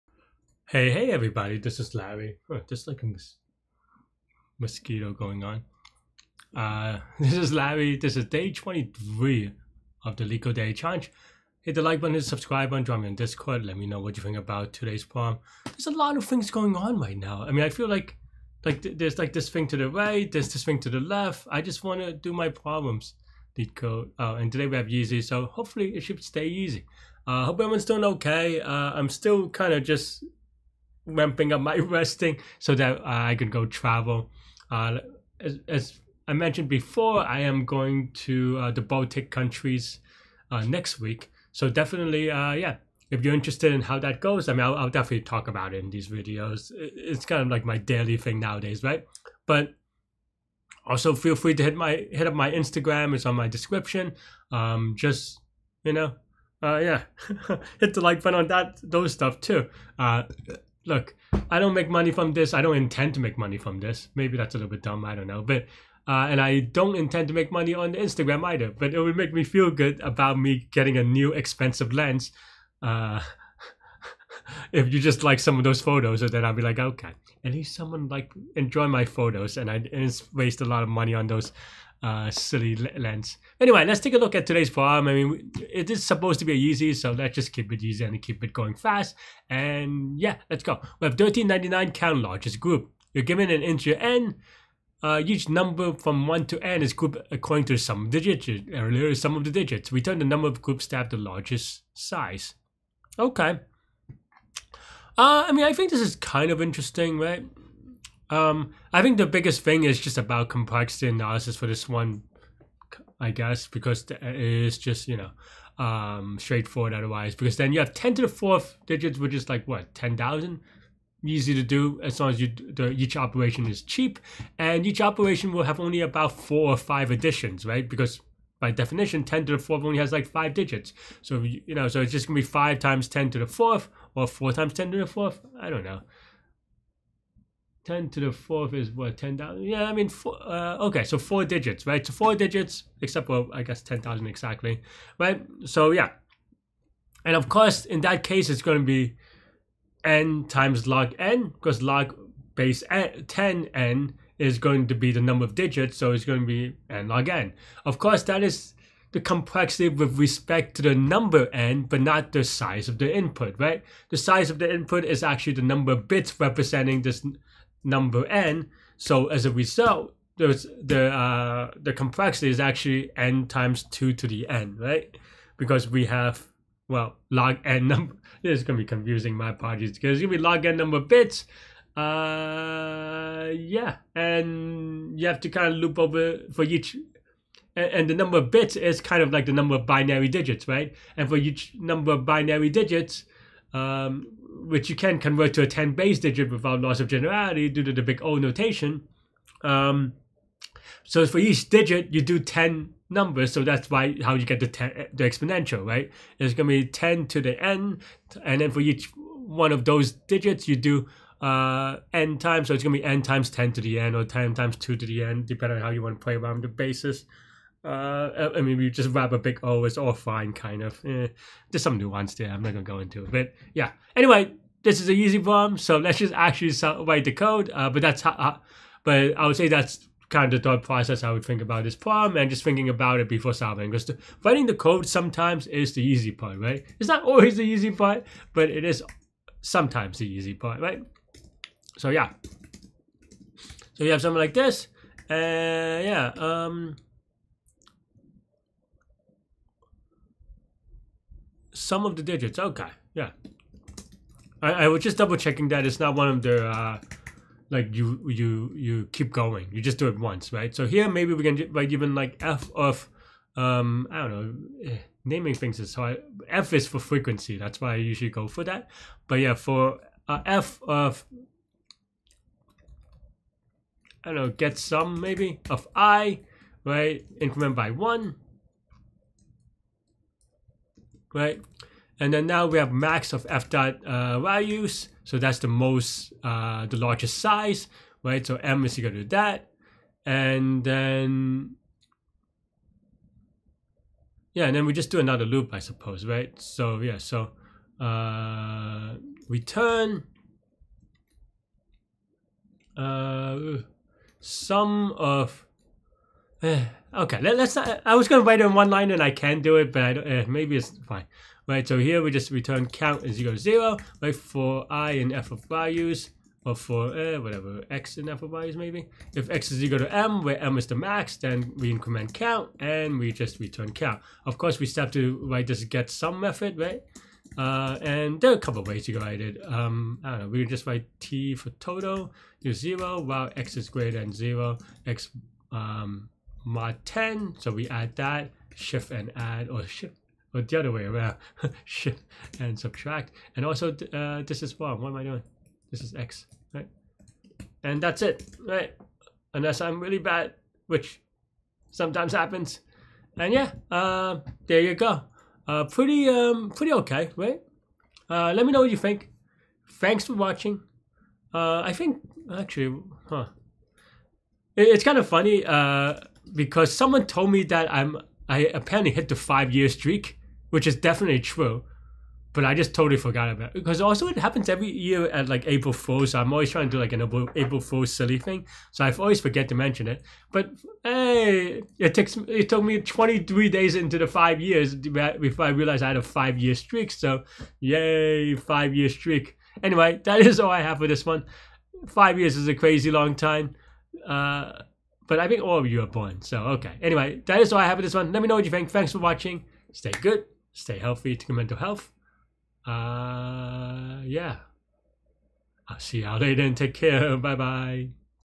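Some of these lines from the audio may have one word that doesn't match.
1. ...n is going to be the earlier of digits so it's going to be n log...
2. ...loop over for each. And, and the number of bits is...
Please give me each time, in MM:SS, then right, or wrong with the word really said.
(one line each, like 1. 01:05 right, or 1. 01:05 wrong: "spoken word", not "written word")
1. 02:33 wrong: "number", not "earlier"
2. 03:05 right.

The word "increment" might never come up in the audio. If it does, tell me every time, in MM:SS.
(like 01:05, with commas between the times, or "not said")
04:37, 05:21.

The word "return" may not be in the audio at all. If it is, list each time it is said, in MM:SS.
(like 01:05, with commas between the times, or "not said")
01:39, 04:59, 05:12, 05:23.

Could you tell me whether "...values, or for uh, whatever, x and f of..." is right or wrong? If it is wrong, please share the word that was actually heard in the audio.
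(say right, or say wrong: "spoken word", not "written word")
right.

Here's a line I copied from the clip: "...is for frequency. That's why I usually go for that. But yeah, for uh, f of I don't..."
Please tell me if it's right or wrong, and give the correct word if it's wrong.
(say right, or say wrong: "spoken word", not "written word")
right.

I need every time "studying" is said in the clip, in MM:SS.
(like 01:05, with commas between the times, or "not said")
not said.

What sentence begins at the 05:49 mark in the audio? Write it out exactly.
Unless I'm really bad, which sometimes happens.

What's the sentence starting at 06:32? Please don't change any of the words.
Five years is a crazy long time.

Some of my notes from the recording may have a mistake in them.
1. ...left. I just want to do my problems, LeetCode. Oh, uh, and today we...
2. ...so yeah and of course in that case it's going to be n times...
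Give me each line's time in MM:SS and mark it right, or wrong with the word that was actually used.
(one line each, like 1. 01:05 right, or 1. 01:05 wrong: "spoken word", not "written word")
1. 00:21 right
2. 02:25 right.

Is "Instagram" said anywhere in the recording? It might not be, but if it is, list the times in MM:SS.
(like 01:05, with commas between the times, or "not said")
00:52, 01:07.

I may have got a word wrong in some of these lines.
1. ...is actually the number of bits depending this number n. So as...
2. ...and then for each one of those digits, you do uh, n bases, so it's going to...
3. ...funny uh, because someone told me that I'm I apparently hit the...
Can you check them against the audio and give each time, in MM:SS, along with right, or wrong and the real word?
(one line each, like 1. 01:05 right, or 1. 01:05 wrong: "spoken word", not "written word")
1. 02:45 wrong: "representing", not "depending"
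2. 03:28 wrong: "times", not "bases"
3. 06:05 right.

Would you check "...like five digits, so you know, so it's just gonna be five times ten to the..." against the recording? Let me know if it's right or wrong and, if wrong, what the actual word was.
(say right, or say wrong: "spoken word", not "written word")
right.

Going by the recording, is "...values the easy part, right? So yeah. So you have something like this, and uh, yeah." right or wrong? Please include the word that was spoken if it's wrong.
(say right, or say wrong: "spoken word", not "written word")
wrong: "sometimes", not "values".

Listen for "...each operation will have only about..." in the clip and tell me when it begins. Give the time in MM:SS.
02:04.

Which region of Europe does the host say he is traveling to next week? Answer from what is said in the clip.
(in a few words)
Baltic countries.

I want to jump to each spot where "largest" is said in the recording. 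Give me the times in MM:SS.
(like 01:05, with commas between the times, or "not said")
01:32, 01:41, 04:46.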